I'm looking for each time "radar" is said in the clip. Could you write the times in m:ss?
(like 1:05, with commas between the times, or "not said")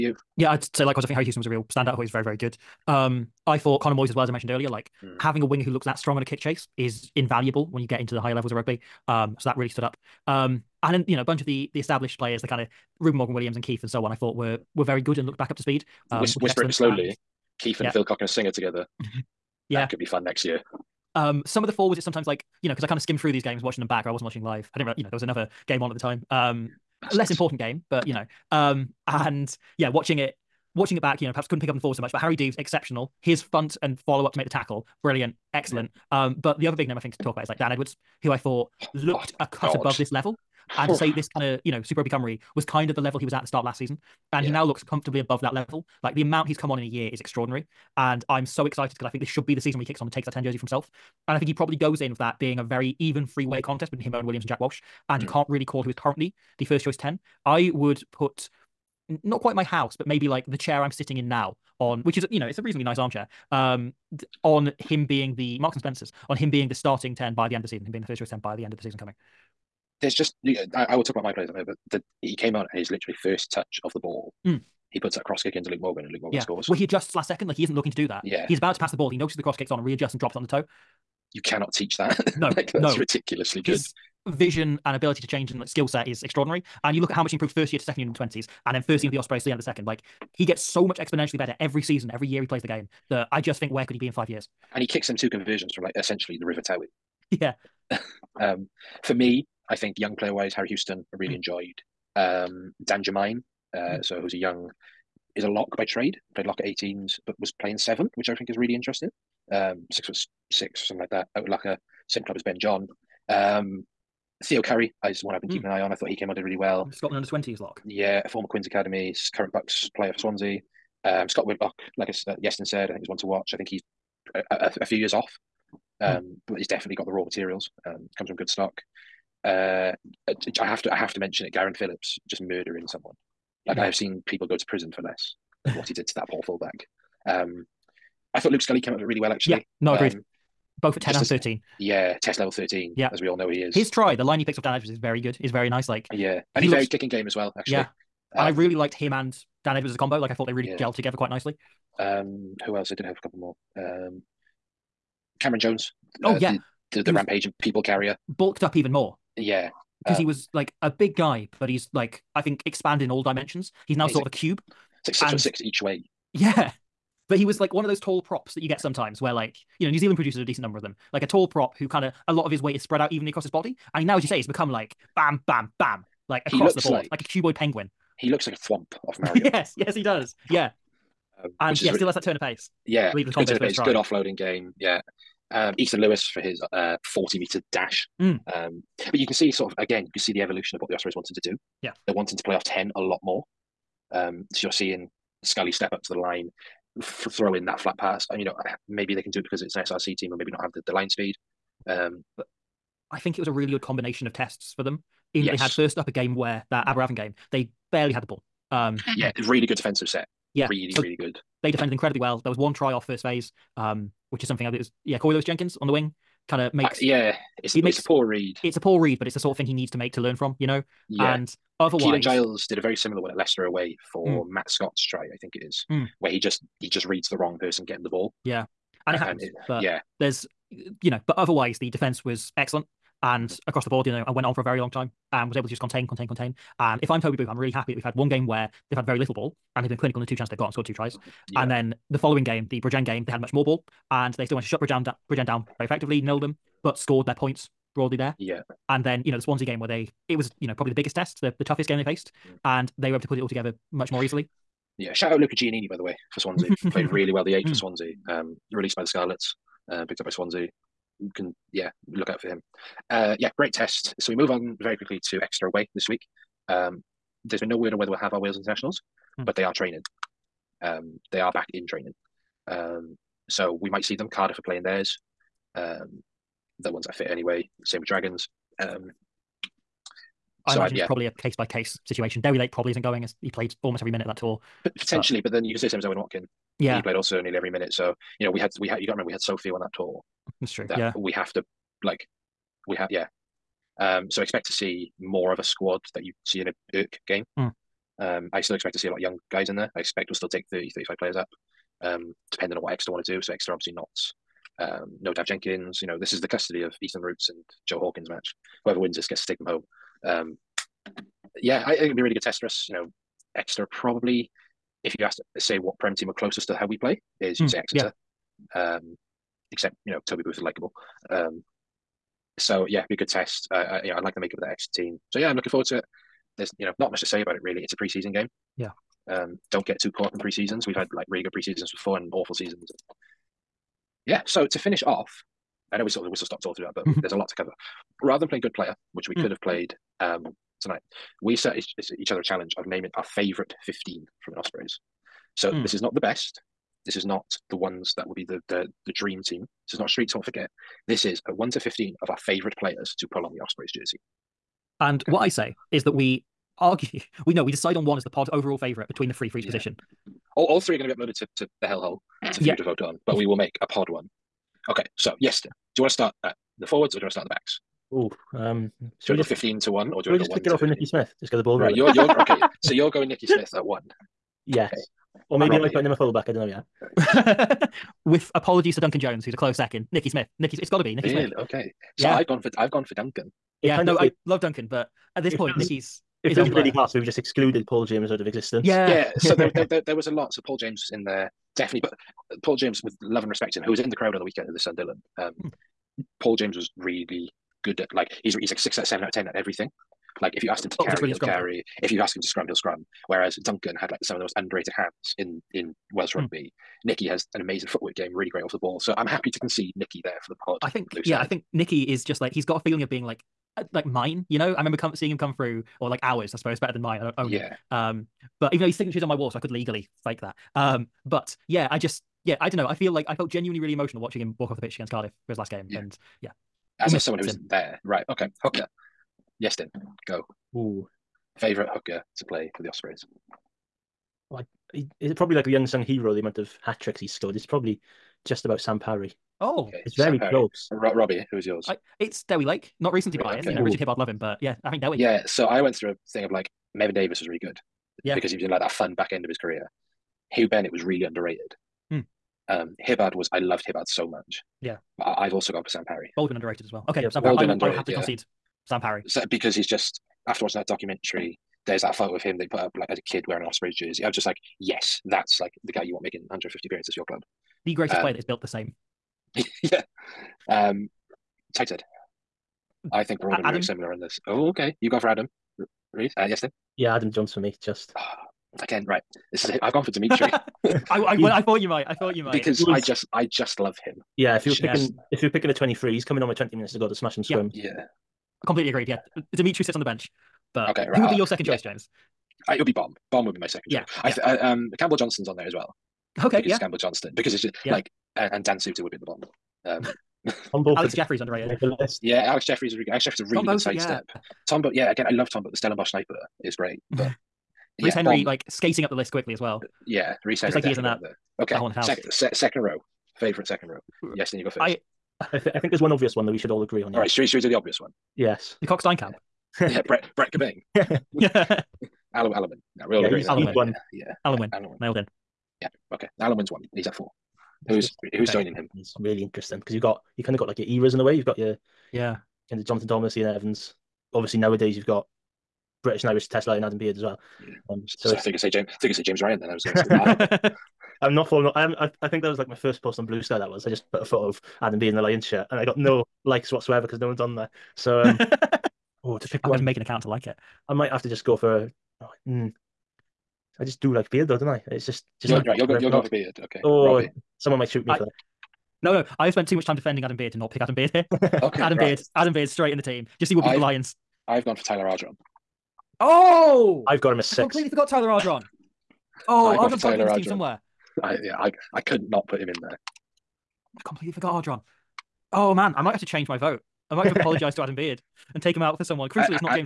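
not said.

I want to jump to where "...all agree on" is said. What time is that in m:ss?
8:36.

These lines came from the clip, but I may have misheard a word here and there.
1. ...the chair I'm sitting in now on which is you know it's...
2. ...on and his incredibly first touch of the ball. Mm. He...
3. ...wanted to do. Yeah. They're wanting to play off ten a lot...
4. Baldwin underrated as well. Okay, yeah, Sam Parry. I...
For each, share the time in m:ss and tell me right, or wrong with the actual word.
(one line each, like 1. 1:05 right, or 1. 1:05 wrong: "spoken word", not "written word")
1. 1:00 right
2. 1:12 wrong: "literally", not "incredibly"
3. 3:11 right
4. 7:36 right.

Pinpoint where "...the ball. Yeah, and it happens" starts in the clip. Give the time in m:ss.
3:48.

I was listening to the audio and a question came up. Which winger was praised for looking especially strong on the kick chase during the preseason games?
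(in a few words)
Connor Moyes.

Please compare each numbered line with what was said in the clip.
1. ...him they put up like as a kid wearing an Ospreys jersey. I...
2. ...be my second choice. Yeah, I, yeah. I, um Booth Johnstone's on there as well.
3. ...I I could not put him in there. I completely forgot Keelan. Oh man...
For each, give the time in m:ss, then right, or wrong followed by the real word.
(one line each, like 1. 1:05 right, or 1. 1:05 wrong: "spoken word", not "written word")
1. 7:42 right
2. 8:13 wrong: "Campbell", not "Booth"
3. 9:31 wrong: "Ardron", not "Keelan".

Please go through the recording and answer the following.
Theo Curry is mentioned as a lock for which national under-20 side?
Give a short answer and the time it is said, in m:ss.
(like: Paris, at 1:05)
Scotland, at 1:56.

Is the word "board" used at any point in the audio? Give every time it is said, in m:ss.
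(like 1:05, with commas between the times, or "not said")
2:56, 3:53.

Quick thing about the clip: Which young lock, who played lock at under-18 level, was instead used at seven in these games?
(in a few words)
Dan Jermaine.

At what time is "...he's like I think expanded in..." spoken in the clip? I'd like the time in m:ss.
2:41.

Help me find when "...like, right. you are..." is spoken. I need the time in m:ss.
9:15.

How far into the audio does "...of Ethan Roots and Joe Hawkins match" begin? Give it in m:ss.
5:06.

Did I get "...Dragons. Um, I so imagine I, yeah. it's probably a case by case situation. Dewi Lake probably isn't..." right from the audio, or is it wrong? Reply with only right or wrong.
right.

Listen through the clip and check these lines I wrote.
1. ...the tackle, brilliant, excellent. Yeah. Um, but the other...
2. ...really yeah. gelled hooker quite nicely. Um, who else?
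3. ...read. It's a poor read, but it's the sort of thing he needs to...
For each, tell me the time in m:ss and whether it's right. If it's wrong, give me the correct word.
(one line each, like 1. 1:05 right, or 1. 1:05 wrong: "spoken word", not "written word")
1. 0:34 right
2. 2:30 wrong: "together", not "hooker"
3. 3:38 right.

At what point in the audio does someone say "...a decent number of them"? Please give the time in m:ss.
2:50.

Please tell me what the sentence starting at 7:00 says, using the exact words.
Um, but yeah, I just yeah, I don't know.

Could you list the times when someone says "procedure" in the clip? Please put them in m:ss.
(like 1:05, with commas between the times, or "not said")
not said.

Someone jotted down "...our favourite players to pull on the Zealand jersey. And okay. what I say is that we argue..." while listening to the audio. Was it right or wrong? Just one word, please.
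wrong.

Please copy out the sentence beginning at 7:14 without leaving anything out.
Well, I, he is probably like the young sung hero, the amount of hat tricks he's scored.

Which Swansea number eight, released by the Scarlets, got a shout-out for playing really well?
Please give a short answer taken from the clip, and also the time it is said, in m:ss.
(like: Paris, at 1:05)
Luca Giannini, at 4:15.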